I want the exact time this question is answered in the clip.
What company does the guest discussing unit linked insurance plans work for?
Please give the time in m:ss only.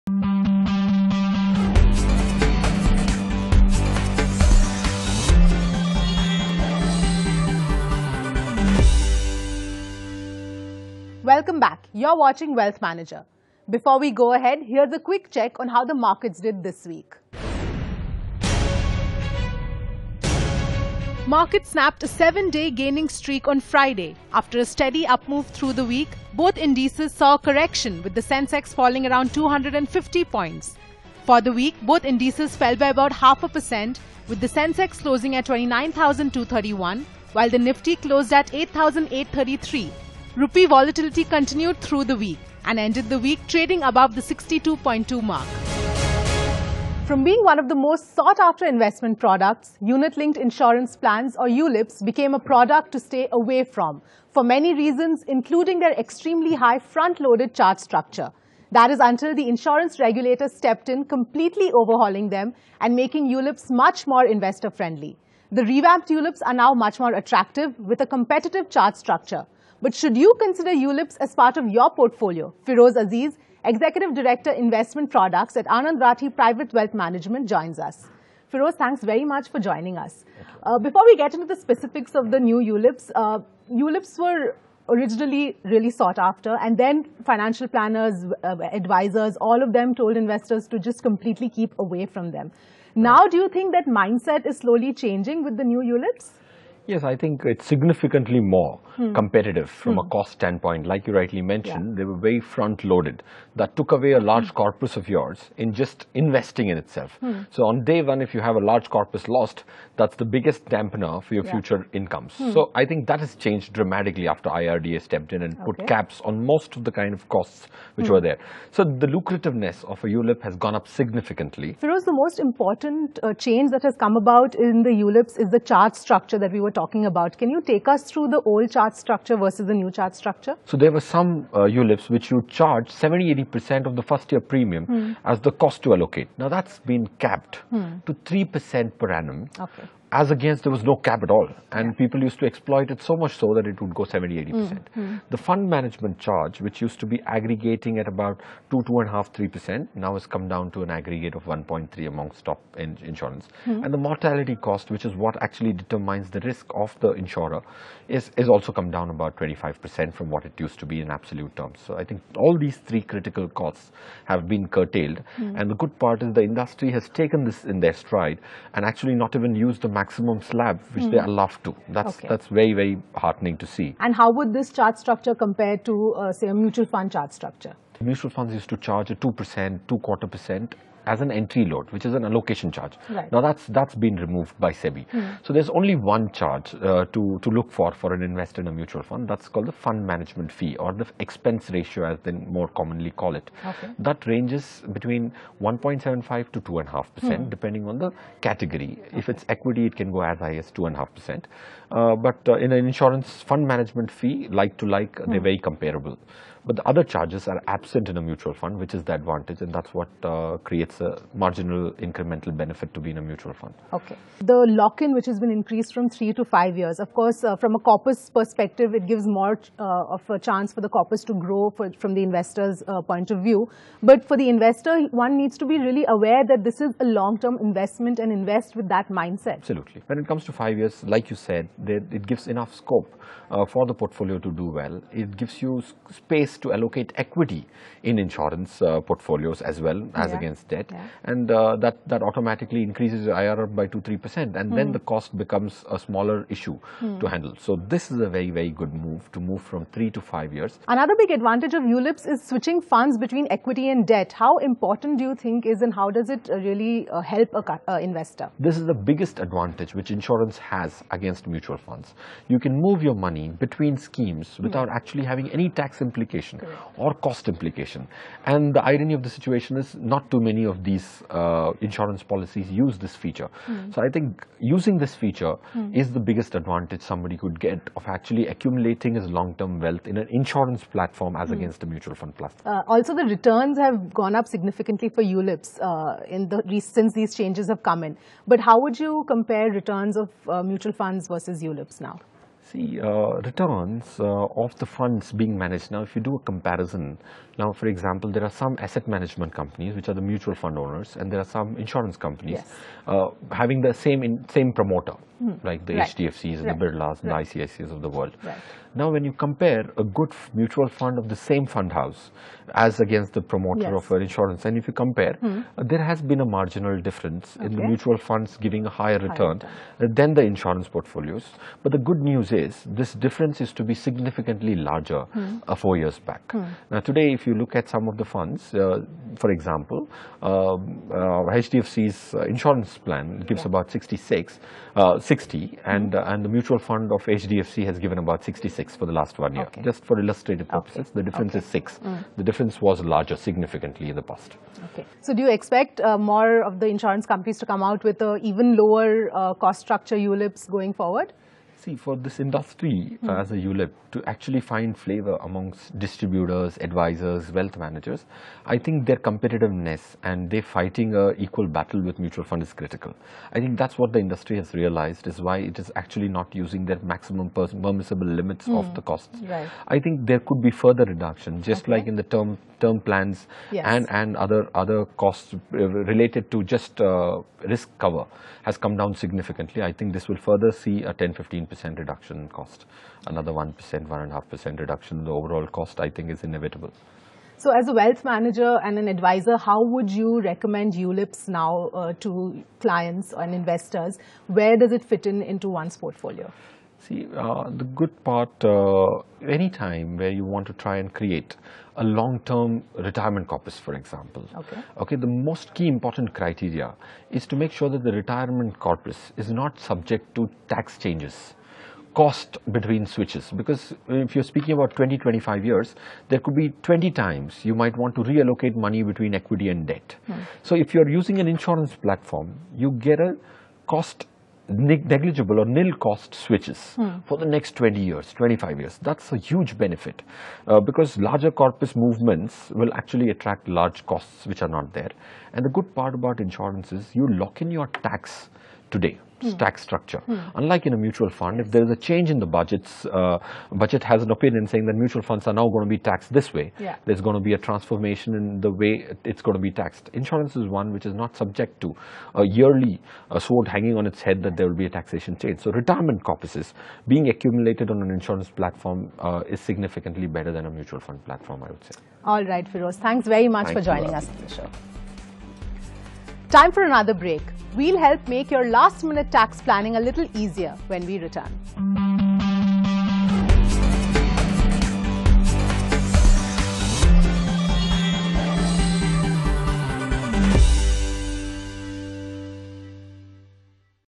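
1:15.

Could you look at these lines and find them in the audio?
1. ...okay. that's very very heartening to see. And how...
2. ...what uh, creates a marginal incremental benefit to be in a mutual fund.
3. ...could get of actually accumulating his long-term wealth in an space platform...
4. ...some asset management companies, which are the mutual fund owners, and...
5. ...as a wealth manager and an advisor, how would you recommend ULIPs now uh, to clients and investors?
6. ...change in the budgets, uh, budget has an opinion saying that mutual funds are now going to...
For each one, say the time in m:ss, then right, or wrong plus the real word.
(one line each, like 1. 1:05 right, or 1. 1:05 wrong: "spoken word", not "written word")
1. 2:52 right
2. 3:29 right
3. 4:37 wrong: "insurance", not "space"
4. 4:58 right
5. 6:27 right
6. 7:21 right.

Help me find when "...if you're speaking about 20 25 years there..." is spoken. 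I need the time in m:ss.
6:54.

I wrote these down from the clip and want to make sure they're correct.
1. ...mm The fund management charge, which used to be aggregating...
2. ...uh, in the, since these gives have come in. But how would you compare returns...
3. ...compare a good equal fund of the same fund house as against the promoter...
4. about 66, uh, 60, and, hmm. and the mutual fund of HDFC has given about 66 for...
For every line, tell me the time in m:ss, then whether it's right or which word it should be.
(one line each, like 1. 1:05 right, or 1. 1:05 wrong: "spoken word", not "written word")
1. 2:25 right
2. 4:45 wrong: "changes", not "gives"
3. 5:09 wrong: "mutual", not "equal"
4. 5:33 right.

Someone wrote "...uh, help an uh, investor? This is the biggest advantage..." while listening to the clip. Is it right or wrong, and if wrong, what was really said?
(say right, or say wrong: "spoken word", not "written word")
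right.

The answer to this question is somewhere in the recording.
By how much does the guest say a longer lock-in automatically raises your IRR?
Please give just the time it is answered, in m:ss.
4:03.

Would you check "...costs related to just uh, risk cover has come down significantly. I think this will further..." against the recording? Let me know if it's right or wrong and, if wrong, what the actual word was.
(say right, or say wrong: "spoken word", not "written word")
right.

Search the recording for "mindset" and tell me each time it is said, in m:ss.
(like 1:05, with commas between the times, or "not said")
1:33, 3:49.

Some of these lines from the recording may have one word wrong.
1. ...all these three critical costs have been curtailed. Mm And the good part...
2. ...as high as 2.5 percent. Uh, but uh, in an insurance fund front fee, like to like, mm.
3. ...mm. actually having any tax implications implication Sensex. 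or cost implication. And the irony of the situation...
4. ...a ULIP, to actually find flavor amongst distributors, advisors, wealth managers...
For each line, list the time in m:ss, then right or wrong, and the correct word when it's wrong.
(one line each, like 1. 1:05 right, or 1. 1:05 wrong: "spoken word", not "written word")
1. 2:42 right
2. 3:20 wrong: "management", not "front"
3. 4:24 wrong: "Correct", not "Sensex"
4. 5:53 right.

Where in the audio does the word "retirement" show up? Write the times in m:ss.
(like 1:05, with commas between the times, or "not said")
6:42, 6:48, 7:35.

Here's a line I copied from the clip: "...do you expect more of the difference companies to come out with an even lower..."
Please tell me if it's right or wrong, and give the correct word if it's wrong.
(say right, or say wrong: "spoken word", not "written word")
wrong: "insurance", not "difference".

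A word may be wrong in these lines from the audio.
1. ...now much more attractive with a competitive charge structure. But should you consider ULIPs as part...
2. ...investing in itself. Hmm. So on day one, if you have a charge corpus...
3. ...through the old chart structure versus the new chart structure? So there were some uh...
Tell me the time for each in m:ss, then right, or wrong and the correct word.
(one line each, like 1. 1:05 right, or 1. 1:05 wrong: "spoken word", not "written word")
1. 1:06 right
2. 1:46 wrong: "large", not "charge"
3. 2:08 right.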